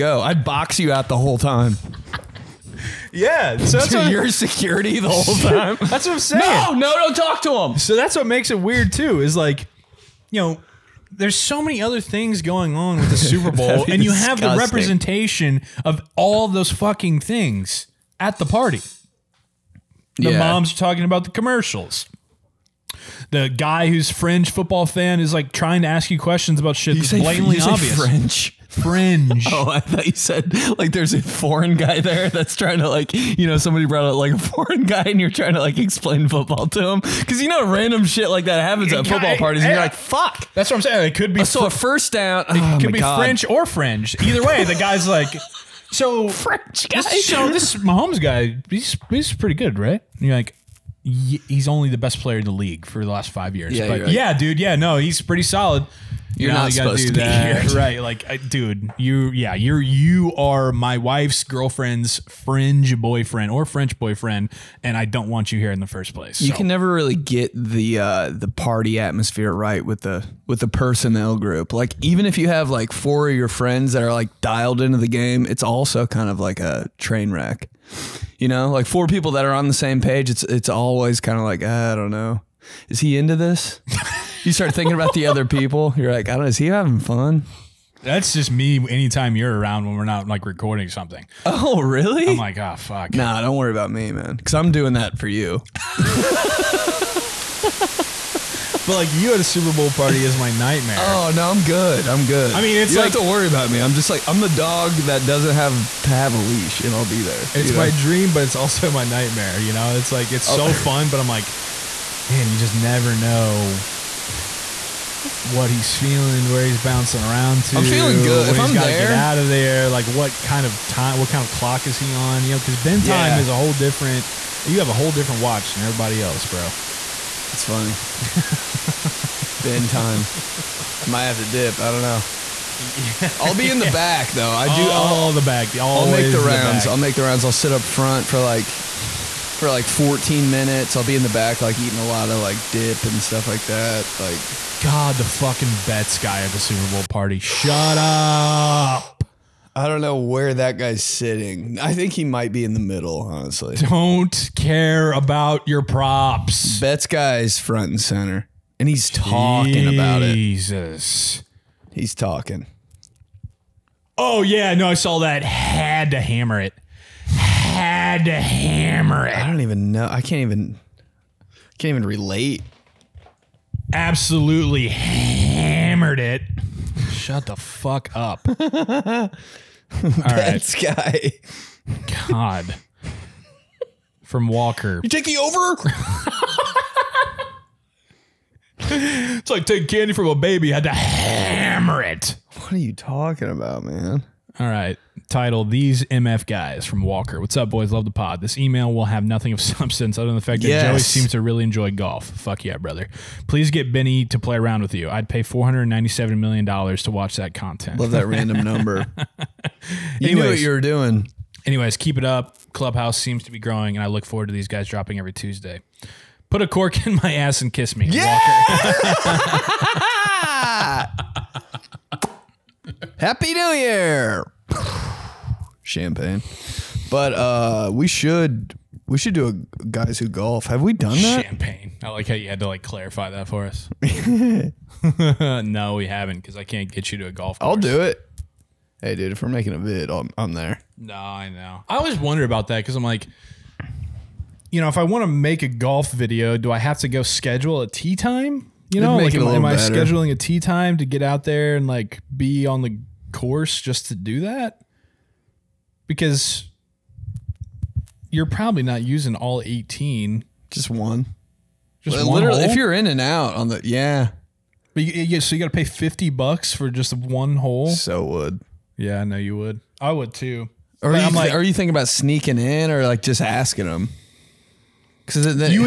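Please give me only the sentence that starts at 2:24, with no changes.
Like God, the fucking bets guy at the Super Bowl party.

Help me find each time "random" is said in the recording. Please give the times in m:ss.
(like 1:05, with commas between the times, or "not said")
0:37, 3:28.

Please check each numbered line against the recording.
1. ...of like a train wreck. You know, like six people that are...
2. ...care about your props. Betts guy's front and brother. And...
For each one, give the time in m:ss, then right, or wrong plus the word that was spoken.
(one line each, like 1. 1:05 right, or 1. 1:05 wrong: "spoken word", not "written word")
1. 1:16 wrong: "four", not "six"
2. 2:34 wrong: "center", not "brother".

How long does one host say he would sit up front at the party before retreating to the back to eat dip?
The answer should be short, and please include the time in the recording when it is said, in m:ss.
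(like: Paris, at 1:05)
14 minutes, at 2:19.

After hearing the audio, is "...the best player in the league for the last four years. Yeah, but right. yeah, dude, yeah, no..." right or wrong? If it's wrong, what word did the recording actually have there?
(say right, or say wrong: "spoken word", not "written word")
wrong: "five", not "four".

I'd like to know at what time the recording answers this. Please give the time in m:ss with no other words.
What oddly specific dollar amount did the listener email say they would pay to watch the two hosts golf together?
3:25.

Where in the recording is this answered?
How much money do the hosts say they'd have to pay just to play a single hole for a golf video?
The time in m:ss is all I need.
4:25.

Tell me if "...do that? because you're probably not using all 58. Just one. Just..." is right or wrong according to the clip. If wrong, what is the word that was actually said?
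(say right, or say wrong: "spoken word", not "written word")
wrong: "18", not "58".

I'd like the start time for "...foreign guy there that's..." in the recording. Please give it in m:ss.
0:31.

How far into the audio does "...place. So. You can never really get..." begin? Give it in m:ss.
1:06.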